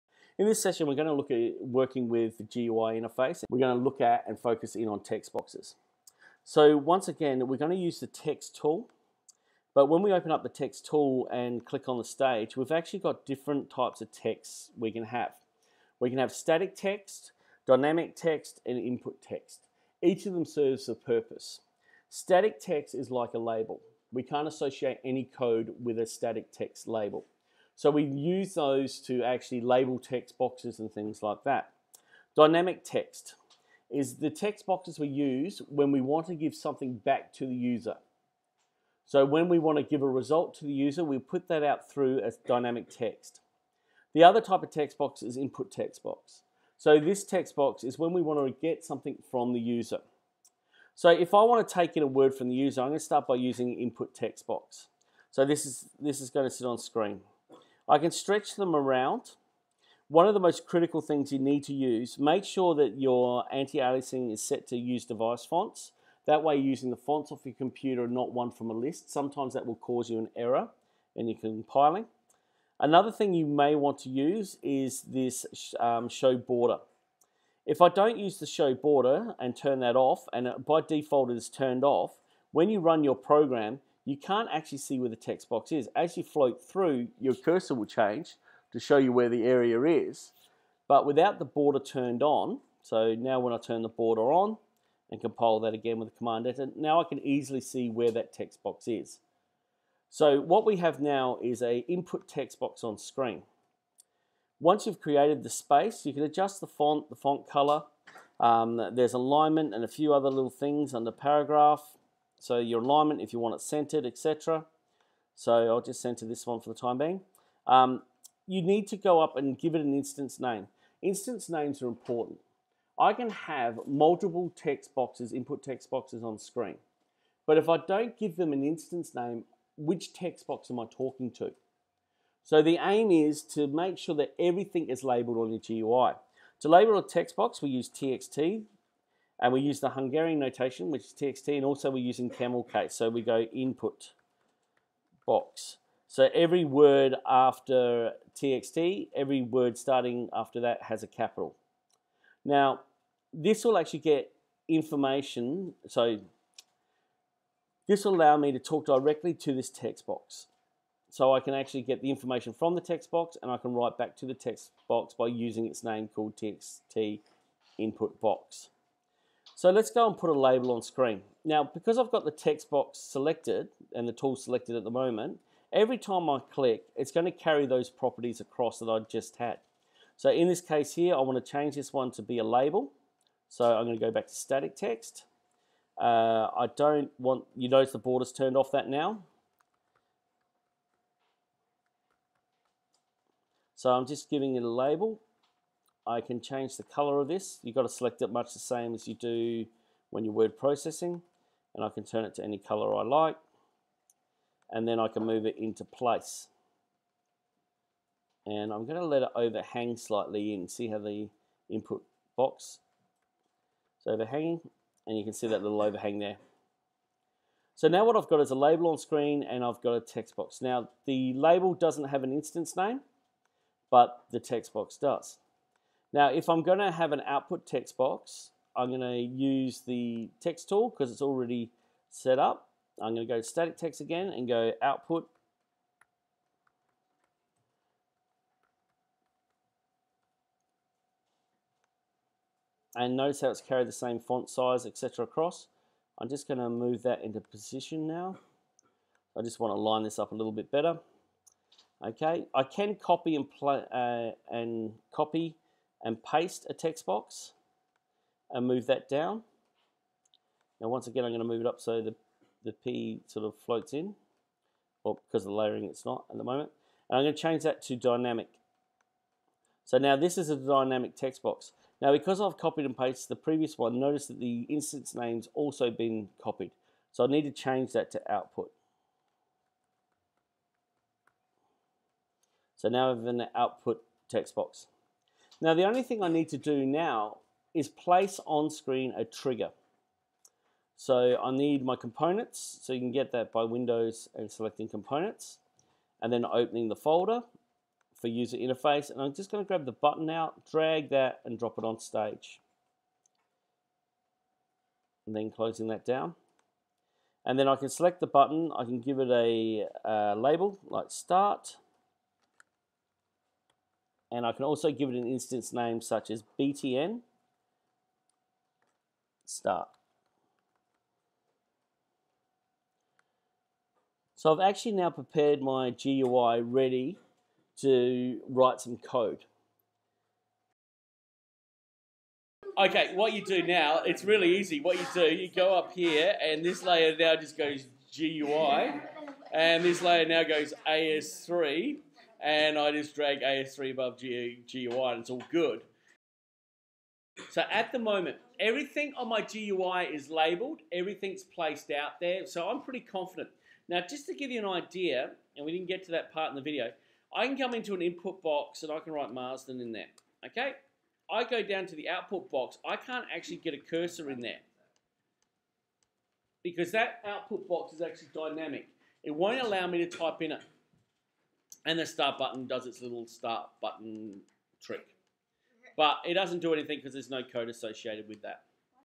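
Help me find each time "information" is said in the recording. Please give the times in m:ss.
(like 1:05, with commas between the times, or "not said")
2:34, 2:42.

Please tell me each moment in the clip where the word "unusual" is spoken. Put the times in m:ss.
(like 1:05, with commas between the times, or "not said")
not said.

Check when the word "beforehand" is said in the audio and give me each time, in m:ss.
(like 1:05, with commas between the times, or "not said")
not said.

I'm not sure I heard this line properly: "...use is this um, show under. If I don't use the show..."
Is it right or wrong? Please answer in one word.
wrong.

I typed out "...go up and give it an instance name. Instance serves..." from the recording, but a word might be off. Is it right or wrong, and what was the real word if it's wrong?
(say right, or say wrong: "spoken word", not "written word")
wrong: "names", not "serves".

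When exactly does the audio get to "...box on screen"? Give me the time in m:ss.
1:42.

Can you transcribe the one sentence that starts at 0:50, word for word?
So if I want to take in a word from the user, I'm going to start by using input text box.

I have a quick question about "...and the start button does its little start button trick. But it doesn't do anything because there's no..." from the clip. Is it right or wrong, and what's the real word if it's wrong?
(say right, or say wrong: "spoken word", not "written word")
right.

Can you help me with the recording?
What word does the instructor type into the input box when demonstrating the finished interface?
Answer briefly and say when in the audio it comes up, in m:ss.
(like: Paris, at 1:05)
Marsden, at 5:59.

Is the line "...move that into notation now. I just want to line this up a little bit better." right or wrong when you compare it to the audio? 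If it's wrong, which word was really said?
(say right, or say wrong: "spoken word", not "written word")
wrong: "position", not "notation".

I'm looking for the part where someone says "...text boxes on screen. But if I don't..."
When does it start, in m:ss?
2:05.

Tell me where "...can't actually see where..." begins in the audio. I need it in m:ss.
1:24.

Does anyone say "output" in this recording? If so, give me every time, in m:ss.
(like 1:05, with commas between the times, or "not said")
3:47, 3:54, 4:38, 4:43, 6:02, 6:07.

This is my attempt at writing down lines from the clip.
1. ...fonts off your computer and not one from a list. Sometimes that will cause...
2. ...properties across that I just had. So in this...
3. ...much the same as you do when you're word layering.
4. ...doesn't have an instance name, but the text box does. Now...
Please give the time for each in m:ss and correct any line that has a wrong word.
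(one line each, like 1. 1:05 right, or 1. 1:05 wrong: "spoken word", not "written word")
1. 1:06 right
2. 2:57 right
3. 3:18 wrong: "processing", not "layering"
4. 3:41 right.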